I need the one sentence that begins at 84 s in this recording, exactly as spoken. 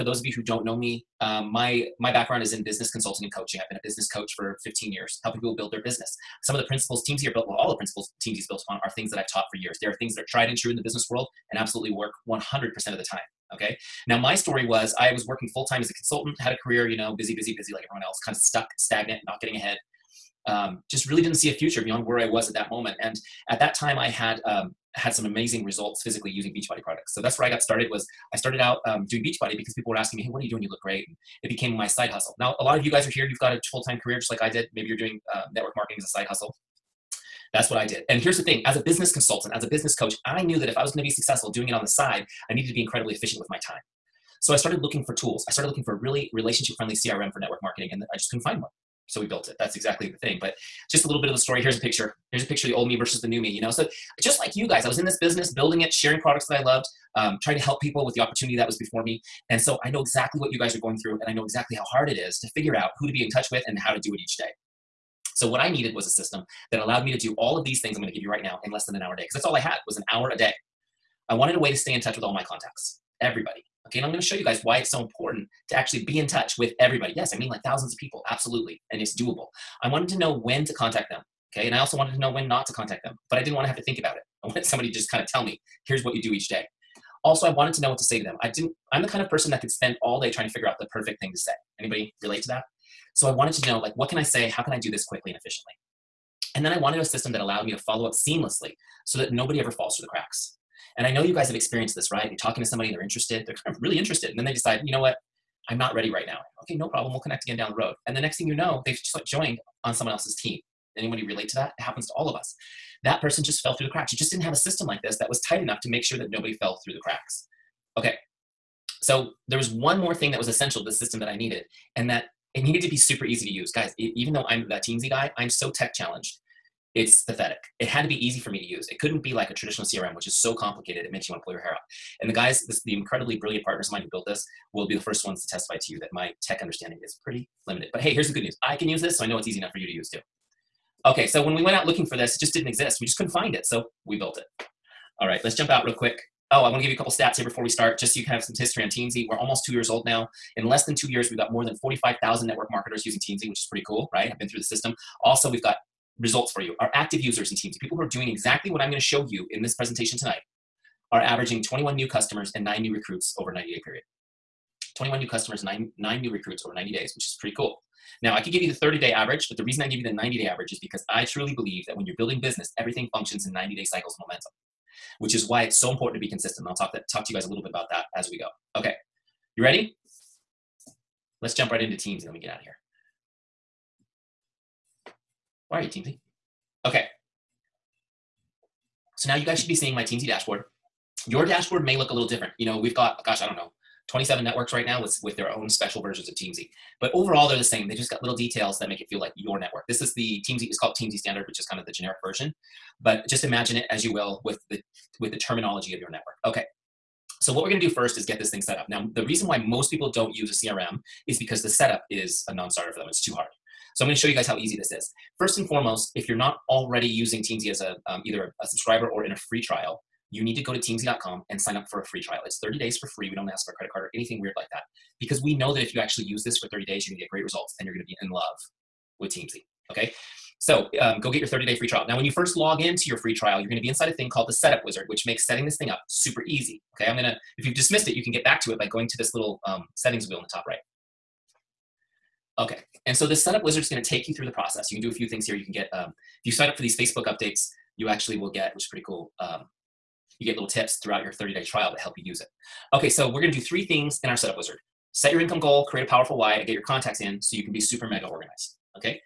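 I wanted somebody to just kind of tell me, here's what you do each day.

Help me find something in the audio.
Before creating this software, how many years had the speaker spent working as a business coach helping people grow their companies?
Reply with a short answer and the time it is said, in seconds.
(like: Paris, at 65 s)
15 years, at 4 s.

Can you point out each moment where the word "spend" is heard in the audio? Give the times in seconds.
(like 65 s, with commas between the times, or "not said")
89 s.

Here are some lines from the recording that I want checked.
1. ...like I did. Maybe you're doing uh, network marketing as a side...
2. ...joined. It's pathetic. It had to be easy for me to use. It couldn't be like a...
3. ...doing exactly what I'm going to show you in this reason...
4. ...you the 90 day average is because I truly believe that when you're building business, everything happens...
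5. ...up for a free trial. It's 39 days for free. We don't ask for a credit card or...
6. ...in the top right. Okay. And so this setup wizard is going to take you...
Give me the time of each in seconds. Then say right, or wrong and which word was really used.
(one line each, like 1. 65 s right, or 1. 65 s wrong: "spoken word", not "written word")
1. 34 s right
2. 125 s wrong: "challenged", not "joined"
3. 158 s wrong: "presentation", not "reason"
4. 169 s wrong: "functions", not "happens"
5. 221 s wrong: "30", not "39"
6. 240 s right.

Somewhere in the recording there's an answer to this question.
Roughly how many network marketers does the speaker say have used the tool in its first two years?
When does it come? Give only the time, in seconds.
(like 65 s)
151 s.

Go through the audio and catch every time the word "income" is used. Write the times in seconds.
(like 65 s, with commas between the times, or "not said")
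255 s.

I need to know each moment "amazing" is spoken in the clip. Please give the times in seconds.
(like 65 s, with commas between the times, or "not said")
25 s.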